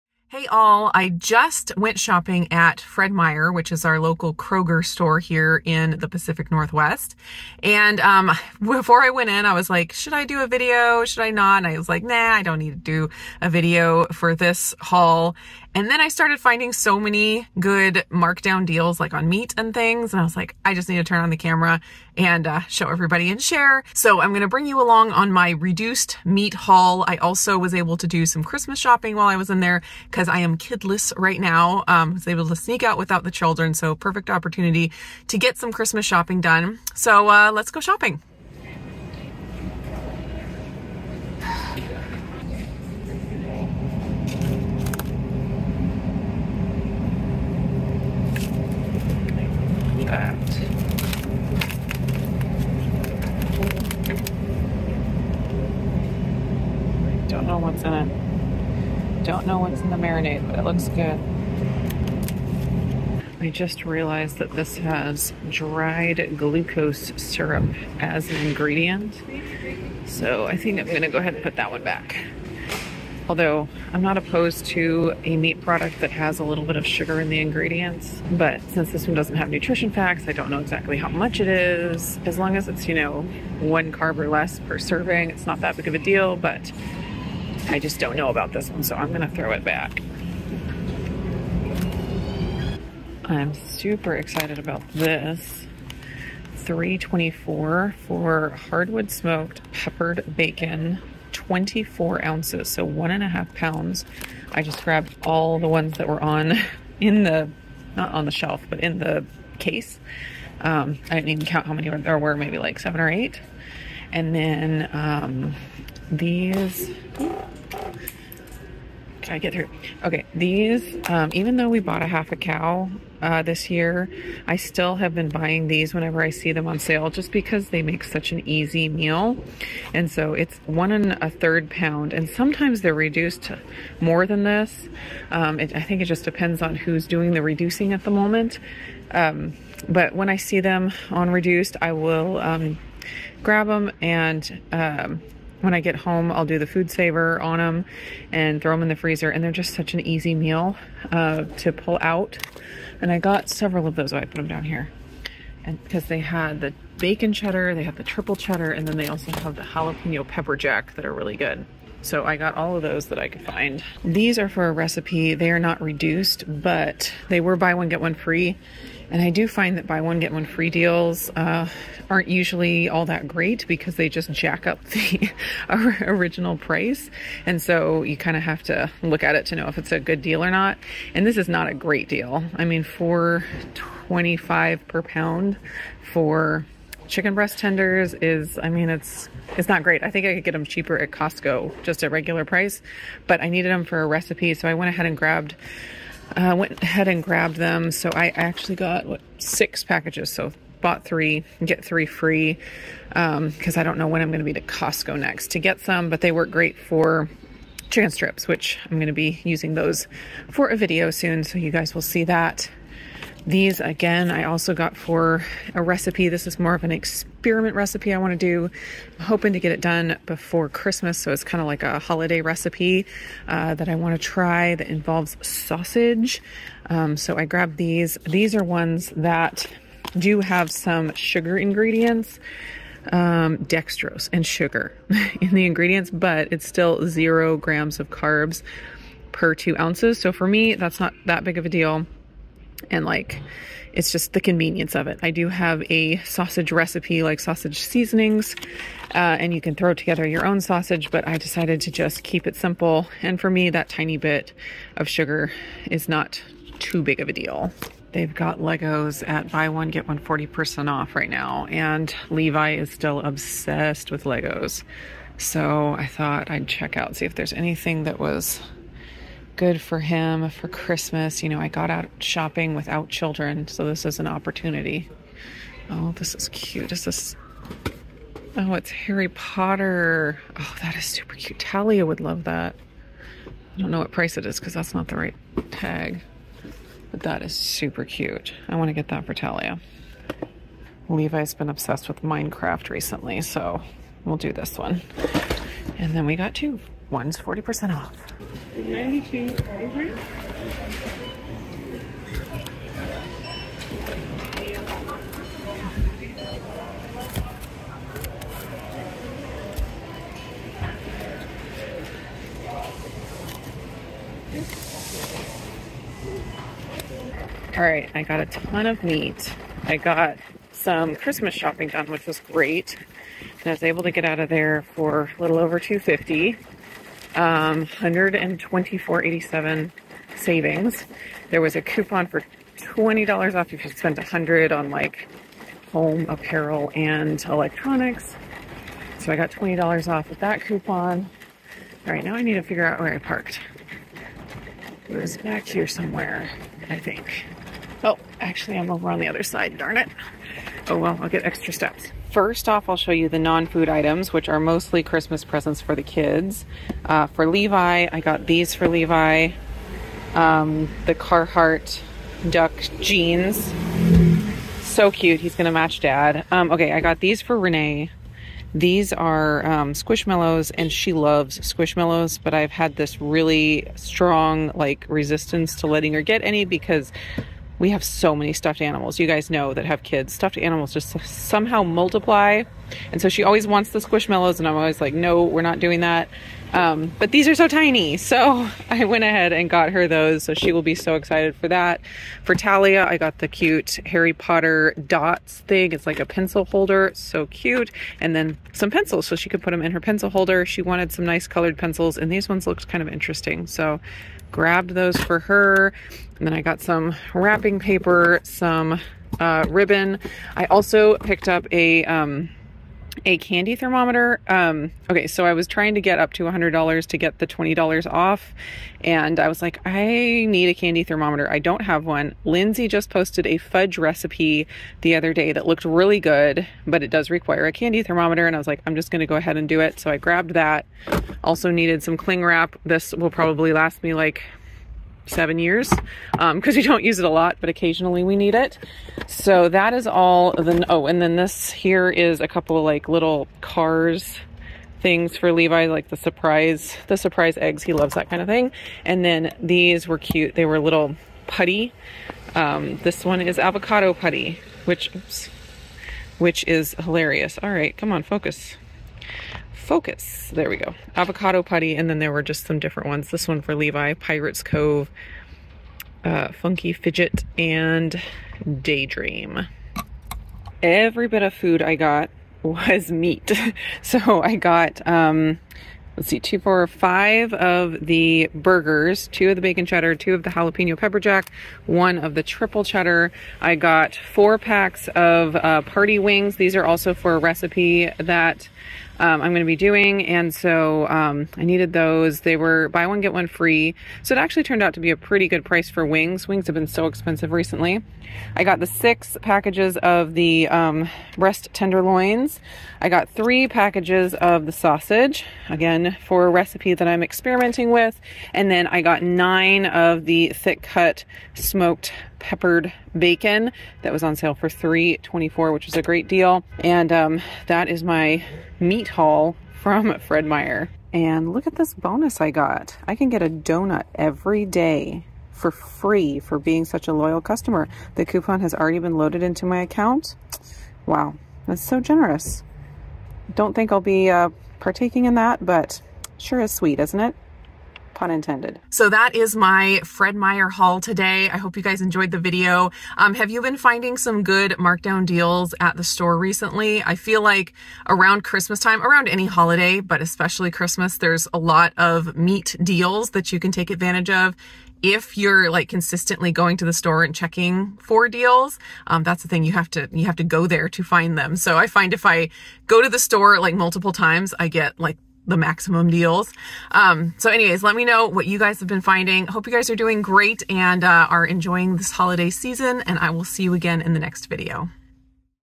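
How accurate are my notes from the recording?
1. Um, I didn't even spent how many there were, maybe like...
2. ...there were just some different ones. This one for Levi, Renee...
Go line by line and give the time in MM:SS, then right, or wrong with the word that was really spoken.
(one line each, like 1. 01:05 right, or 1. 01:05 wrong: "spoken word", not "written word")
1. 01:50 wrong: "count", not "spent"
2. 07:42 wrong: "Pirates", not "Renee".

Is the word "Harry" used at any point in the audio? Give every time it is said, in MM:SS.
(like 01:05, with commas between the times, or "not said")
04:38, 06:34.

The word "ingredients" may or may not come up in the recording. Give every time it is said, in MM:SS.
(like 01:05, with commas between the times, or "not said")
01:08, 01:17, 03:51, 03:55.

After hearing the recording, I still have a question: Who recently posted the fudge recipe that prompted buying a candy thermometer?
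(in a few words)
Lindsay.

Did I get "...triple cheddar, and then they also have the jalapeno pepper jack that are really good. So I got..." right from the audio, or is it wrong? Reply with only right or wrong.
right.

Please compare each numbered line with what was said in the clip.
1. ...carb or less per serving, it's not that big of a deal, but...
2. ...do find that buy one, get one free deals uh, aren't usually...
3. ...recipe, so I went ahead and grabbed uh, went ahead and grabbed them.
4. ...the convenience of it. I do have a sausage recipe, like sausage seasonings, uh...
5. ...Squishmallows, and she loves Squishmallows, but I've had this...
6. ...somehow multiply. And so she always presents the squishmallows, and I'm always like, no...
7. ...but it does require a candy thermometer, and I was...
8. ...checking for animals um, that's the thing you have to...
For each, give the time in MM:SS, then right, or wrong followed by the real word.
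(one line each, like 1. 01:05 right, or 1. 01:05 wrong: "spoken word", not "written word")
1. 01:23 right
2. 02:49 right
3. 03:14 right
4. 04:04 right
5. 06:09 right
6. 06:21 wrong: "wants", not "presents"
7. 07:06 right
8. 09:17 wrong: "deals", not "animals".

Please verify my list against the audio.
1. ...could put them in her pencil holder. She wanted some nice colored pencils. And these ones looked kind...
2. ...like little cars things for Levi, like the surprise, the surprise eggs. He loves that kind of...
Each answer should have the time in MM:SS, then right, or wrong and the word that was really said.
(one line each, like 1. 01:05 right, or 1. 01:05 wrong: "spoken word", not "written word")
1. 06:39 right
2. 07:22 right.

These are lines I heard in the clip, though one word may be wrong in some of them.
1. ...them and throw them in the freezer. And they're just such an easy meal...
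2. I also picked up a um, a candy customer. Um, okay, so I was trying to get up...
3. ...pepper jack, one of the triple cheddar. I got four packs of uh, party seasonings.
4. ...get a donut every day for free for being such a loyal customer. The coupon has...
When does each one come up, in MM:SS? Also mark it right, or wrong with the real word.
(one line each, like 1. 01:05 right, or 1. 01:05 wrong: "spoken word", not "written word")
1. 02:27 right
2. 06:50 wrong: "thermometer", not "customer"
3. 08:00 wrong: "wings", not "seasonings"
4. 08:43 right.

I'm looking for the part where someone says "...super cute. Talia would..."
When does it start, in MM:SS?
04:41.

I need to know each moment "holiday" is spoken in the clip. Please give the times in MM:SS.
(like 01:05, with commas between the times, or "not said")
03:41, 09:09, 09:32.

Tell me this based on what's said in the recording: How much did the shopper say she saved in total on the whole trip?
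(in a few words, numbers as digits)
$124.87.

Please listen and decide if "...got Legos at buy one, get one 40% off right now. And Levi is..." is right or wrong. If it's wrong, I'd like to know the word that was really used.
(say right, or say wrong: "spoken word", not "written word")
right.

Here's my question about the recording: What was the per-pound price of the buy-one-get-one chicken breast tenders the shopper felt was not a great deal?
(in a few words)
$4.25.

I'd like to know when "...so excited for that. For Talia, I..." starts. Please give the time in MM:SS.
06:30.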